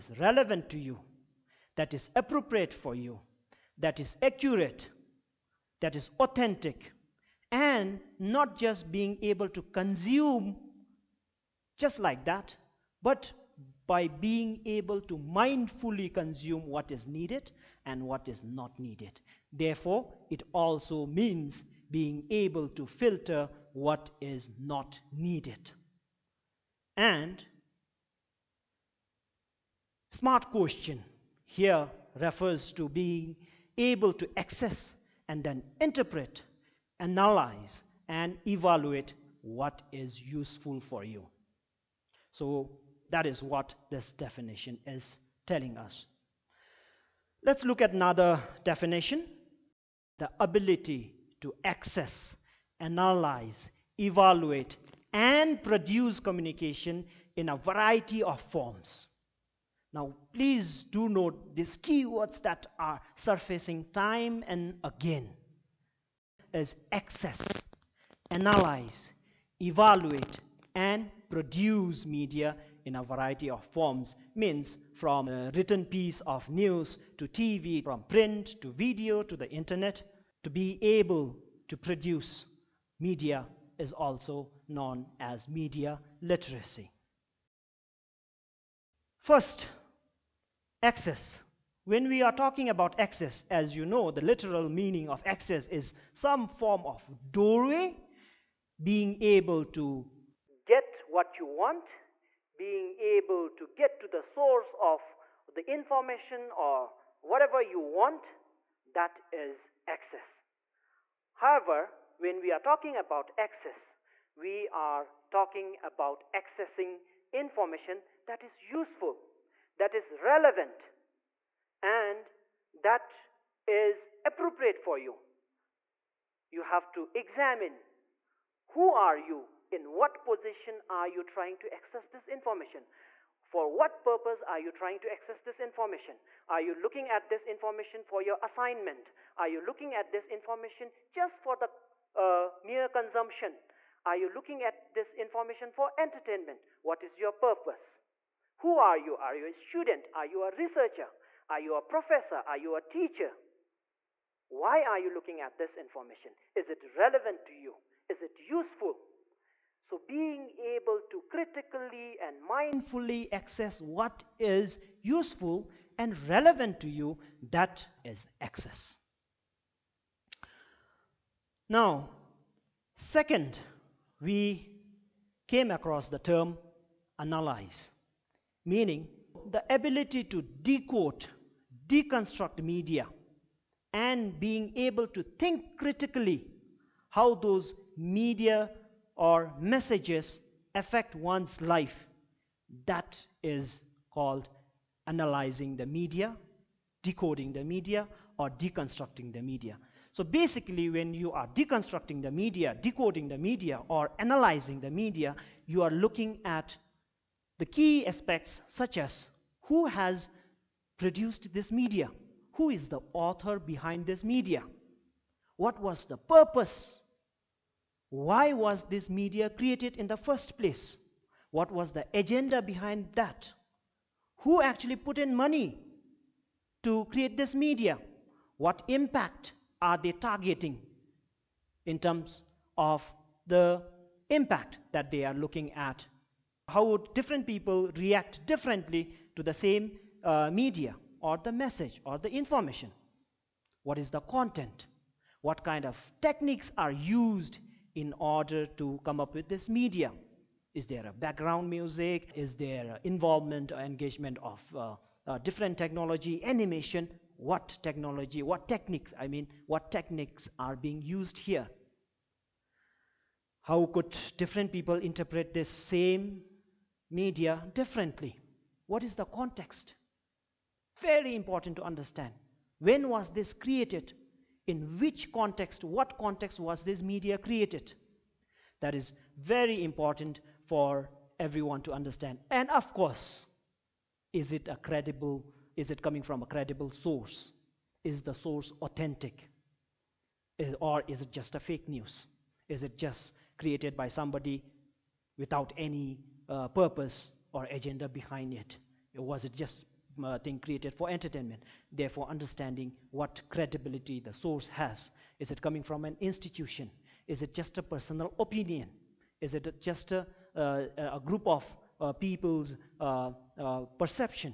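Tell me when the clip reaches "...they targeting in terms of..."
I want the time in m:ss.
3:49.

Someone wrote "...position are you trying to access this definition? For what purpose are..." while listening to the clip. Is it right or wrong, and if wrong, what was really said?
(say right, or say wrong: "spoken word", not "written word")
wrong: "information", not "definition".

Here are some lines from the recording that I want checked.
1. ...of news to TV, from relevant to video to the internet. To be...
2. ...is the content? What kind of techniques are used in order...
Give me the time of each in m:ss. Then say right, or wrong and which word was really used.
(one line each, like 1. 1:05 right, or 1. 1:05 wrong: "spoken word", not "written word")
1. 1:16 wrong: "print", not "relevant"
2. 4:03 right.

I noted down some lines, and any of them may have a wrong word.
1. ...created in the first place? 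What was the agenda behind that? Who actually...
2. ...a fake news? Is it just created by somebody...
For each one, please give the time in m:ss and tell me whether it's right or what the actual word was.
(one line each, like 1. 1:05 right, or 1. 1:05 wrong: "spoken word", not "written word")
1. 3:39 right
2. 4:51 right.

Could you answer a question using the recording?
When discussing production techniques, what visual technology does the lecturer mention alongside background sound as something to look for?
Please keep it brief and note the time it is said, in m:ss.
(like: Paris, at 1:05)
animation, at 4:16.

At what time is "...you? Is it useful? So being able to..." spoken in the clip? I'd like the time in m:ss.
2:37.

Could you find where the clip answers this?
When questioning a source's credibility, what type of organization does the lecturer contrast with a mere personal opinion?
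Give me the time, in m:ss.
5:06.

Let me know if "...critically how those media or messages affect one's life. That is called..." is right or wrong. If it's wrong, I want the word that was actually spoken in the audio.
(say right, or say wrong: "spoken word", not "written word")
right.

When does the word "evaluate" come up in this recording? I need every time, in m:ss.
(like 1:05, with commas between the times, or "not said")
0:38, 0:53, 1:09.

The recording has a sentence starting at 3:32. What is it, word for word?
Who is the author behind this media?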